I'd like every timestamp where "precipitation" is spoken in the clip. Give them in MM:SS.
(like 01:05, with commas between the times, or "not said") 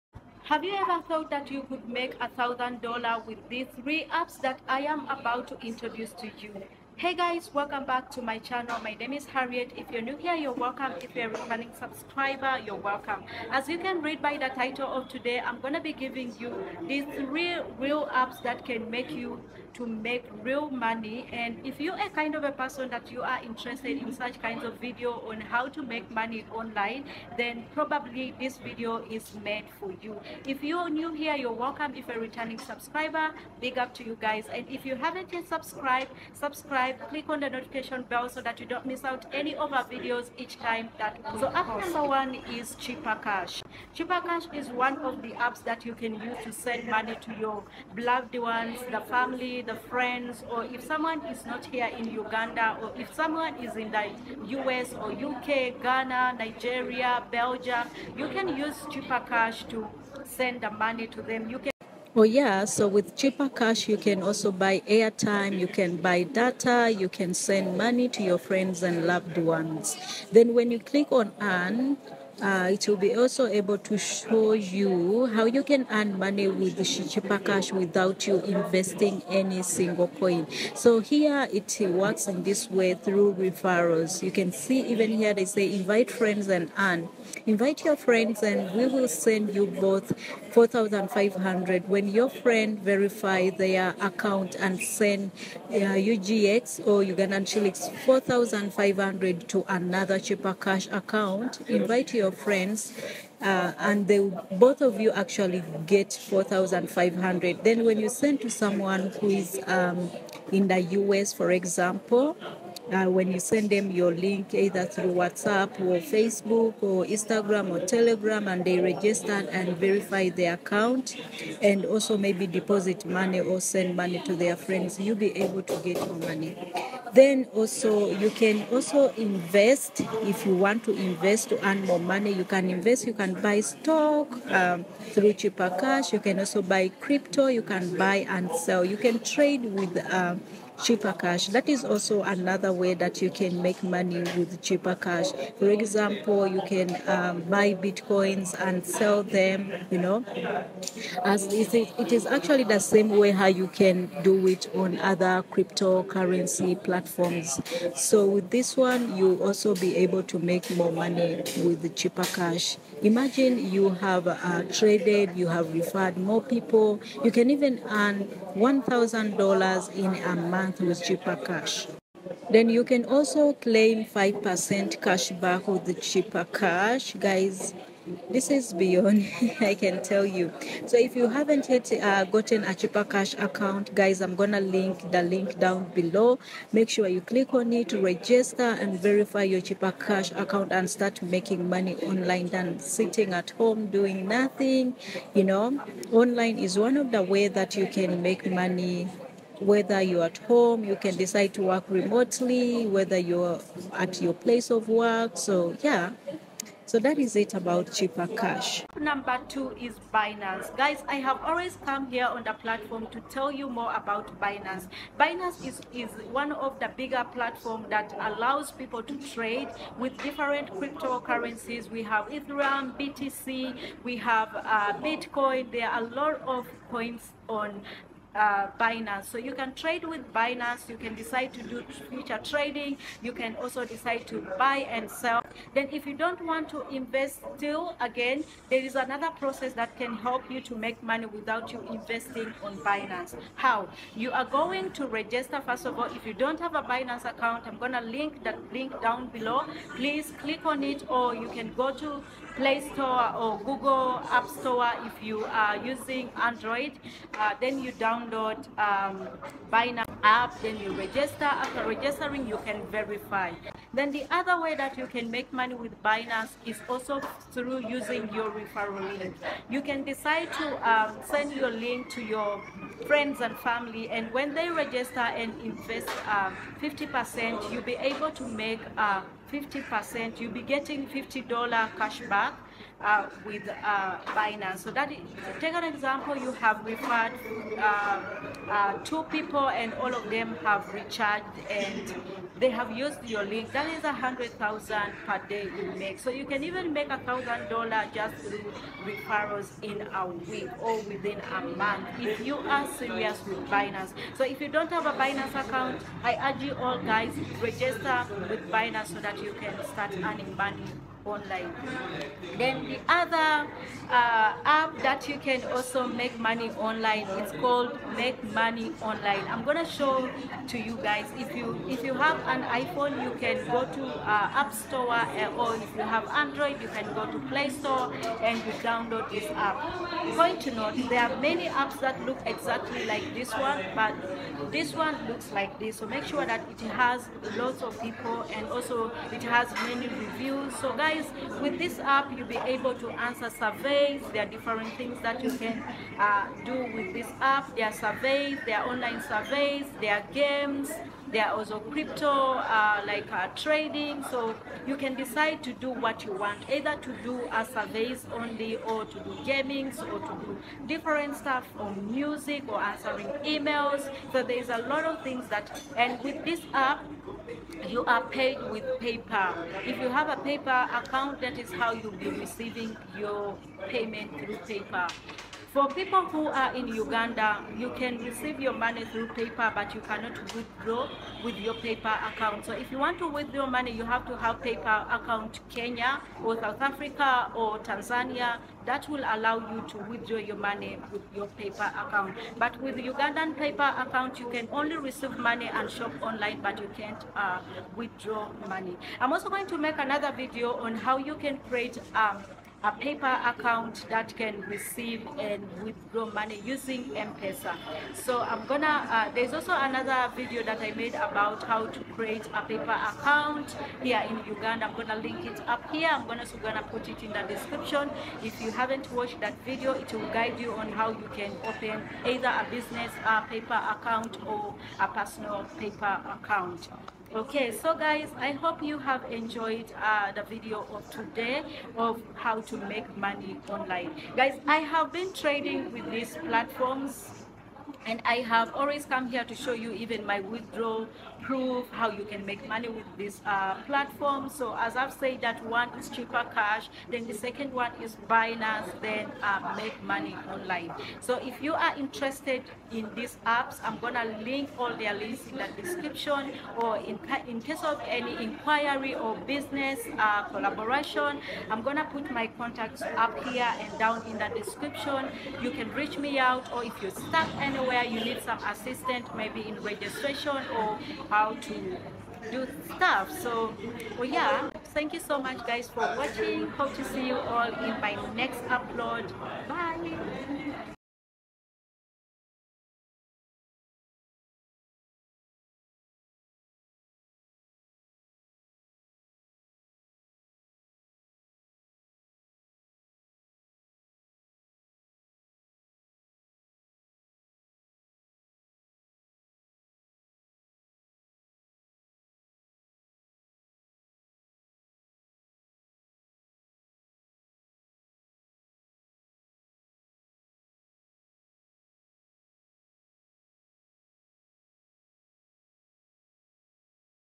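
not said.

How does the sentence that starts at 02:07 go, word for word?
Then also you can also invest if you want to invest to earn more money.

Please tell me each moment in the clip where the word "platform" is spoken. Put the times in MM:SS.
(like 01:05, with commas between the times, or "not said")
02:36, 03:32, 03:37, 07:16, 07:23.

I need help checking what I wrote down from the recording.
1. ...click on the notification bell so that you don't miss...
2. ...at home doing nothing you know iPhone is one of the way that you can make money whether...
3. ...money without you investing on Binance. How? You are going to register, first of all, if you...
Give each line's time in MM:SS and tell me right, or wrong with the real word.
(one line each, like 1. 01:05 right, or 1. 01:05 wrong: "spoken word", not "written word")
1. 00:37 right
2. 03:13 wrong: "online", not "iPhone"
3. 04:01 right.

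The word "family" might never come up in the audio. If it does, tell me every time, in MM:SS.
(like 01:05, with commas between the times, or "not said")
00:49, 04:33.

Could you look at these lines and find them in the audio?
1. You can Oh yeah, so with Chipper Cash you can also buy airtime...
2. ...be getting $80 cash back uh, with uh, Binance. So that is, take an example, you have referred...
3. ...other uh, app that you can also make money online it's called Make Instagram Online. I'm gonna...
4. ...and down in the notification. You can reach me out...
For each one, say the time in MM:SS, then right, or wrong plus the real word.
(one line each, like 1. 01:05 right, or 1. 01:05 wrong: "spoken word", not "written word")
1. 01:01 right
2. 04:40 wrong: "50", not "80"
3. 05:13 wrong: "Money", not "Instagram"
4. 07:43 wrong: "description", not "notification".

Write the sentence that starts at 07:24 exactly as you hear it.
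So as I've said that one is Chipper Cash, then the second one is Binance, then uh, make money online.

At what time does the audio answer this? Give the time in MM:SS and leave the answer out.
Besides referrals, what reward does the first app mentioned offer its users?
02:54.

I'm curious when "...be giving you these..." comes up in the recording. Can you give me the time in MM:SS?
00:15.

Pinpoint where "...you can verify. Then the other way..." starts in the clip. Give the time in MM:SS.
04:22.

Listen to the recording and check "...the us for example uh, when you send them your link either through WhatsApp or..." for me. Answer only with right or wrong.
right.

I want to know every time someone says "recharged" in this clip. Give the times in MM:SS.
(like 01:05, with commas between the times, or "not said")
04:50.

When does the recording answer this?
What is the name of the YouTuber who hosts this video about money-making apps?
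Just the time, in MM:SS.
00:09.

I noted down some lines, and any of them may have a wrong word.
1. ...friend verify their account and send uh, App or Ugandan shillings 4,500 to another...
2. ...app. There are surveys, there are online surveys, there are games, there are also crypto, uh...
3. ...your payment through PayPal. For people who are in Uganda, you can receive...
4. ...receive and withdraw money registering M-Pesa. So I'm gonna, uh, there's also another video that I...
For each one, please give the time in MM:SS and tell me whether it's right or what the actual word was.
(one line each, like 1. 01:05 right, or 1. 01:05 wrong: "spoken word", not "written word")
1. 01:32 wrong: "UGX", not "App"
2. 05:47 right
3. 06:13 right
4. 06:44 wrong: "using", not "registering".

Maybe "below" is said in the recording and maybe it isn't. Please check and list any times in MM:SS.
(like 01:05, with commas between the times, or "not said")
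03:05, 04:09.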